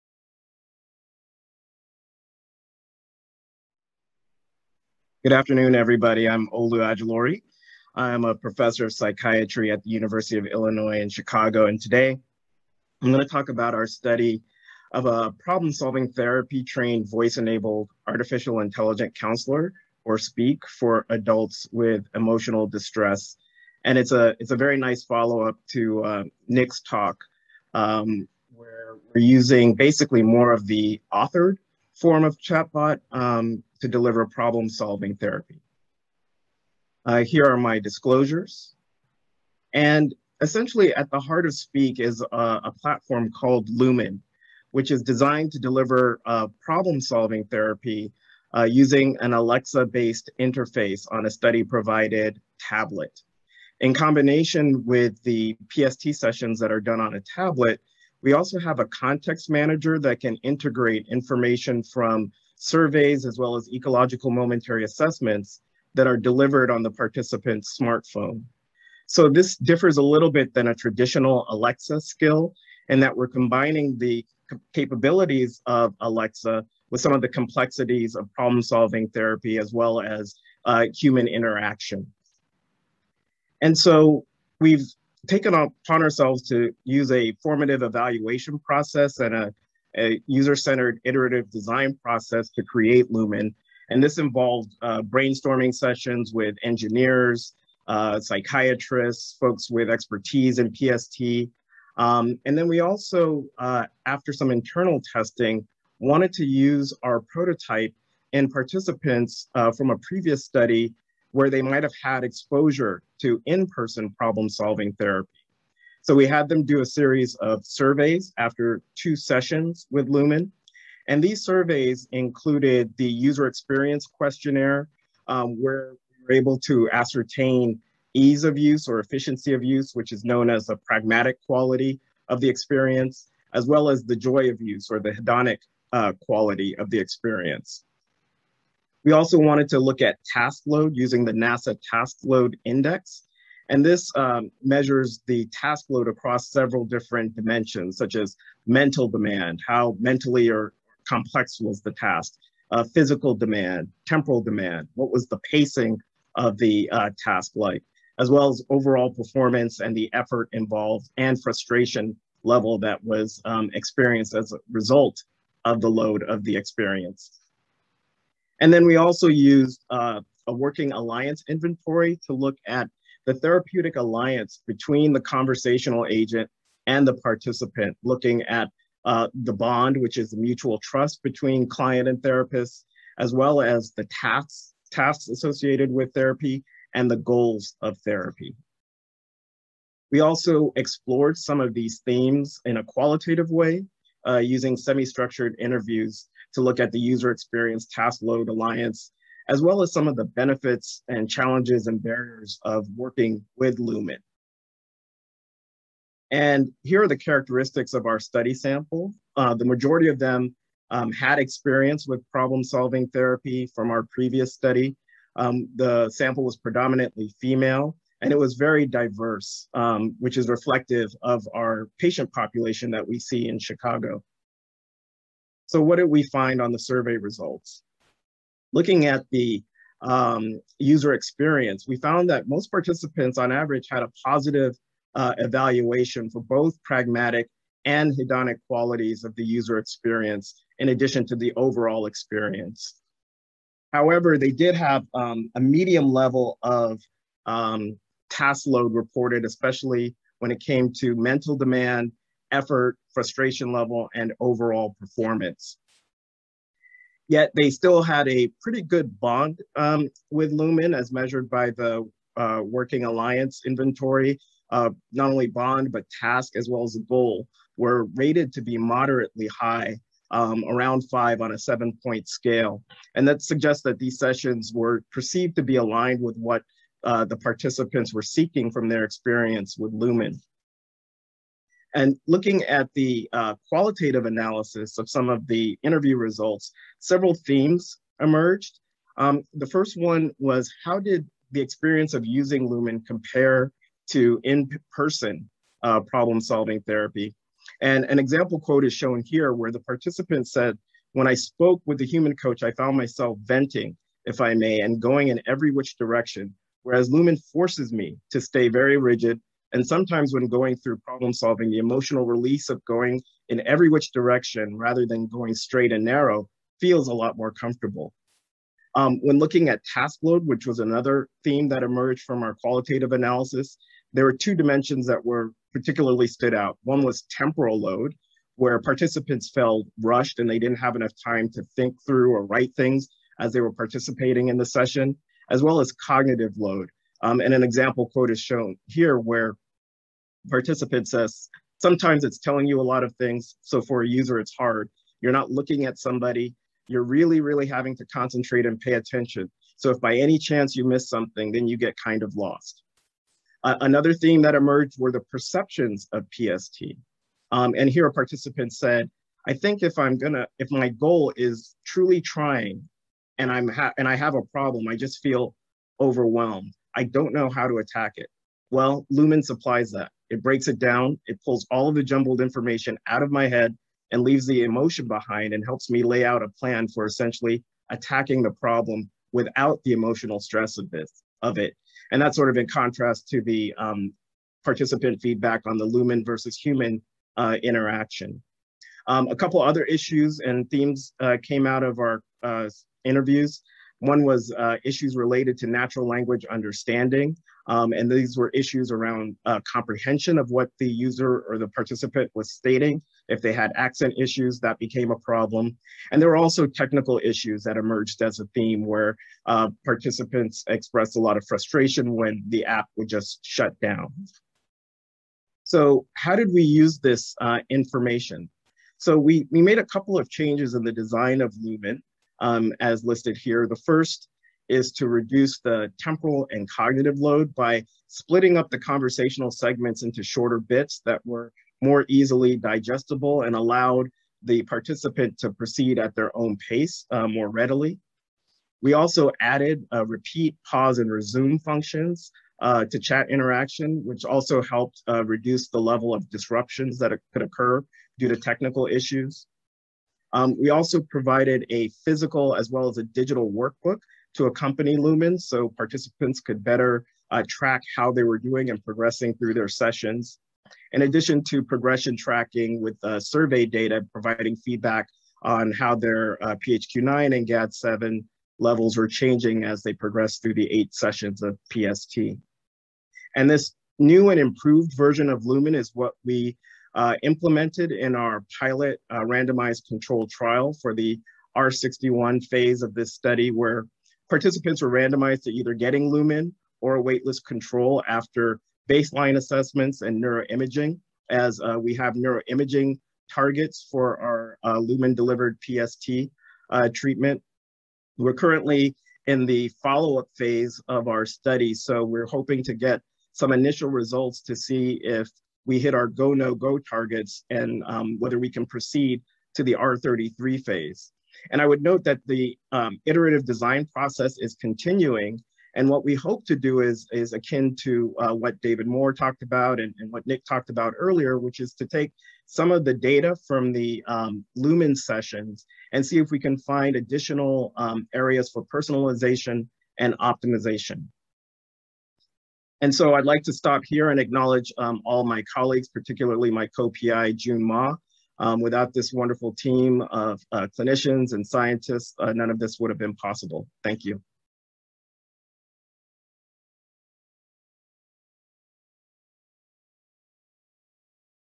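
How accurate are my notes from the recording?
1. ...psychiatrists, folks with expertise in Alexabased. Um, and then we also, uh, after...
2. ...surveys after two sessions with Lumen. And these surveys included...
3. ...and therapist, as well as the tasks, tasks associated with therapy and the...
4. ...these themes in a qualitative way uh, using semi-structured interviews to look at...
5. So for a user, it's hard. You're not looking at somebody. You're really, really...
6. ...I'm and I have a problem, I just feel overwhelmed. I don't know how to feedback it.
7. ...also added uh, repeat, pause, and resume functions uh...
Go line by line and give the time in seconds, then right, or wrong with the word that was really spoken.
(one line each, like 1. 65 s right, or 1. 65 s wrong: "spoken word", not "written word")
1. 98 s wrong: "PST", not "Alexabased"
2. 117 s right
3. 182 s right
4. 191 s right
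5. 343 s right
6. 363 s wrong: "attack", not "feedback"
7. 438 s right.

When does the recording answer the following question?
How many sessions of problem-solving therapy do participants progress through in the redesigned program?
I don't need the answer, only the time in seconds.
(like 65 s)
470 s.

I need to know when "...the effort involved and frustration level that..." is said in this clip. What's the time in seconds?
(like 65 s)
159 s.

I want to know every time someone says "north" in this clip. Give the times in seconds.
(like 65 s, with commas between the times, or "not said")
not said.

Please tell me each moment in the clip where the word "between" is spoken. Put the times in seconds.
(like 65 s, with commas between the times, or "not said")
174 s, 181 s.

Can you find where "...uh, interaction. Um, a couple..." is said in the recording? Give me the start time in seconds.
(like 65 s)
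387 s.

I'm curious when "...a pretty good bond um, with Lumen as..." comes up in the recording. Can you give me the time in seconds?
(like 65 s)
258 s.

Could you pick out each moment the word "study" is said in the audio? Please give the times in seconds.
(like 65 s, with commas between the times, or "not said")
13 s, 51 s, 110 s, 208 s, 214 s, 483 s, 501 s.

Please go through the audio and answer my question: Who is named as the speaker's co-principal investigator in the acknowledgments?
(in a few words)
Jun Ma.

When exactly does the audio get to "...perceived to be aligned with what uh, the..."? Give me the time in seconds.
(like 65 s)
275 s.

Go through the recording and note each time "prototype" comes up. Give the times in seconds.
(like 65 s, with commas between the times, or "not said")
107 s.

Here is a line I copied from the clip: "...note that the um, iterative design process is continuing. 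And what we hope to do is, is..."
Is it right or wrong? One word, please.
right.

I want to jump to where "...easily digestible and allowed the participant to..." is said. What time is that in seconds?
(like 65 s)
432 s.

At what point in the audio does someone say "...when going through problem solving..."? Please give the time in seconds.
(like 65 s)
310 s.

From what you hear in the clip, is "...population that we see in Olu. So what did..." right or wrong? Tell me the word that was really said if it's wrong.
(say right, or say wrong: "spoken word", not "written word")
wrong: "Chicago", not "Olu".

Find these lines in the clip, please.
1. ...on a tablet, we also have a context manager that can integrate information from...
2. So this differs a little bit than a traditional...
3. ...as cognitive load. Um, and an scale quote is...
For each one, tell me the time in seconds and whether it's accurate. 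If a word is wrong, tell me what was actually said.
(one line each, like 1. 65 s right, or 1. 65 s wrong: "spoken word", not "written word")
1. 56 s right
2. 69 s right
3. 335 s wrong: "example", not "scale".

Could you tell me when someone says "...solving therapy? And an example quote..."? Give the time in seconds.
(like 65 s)
296 s.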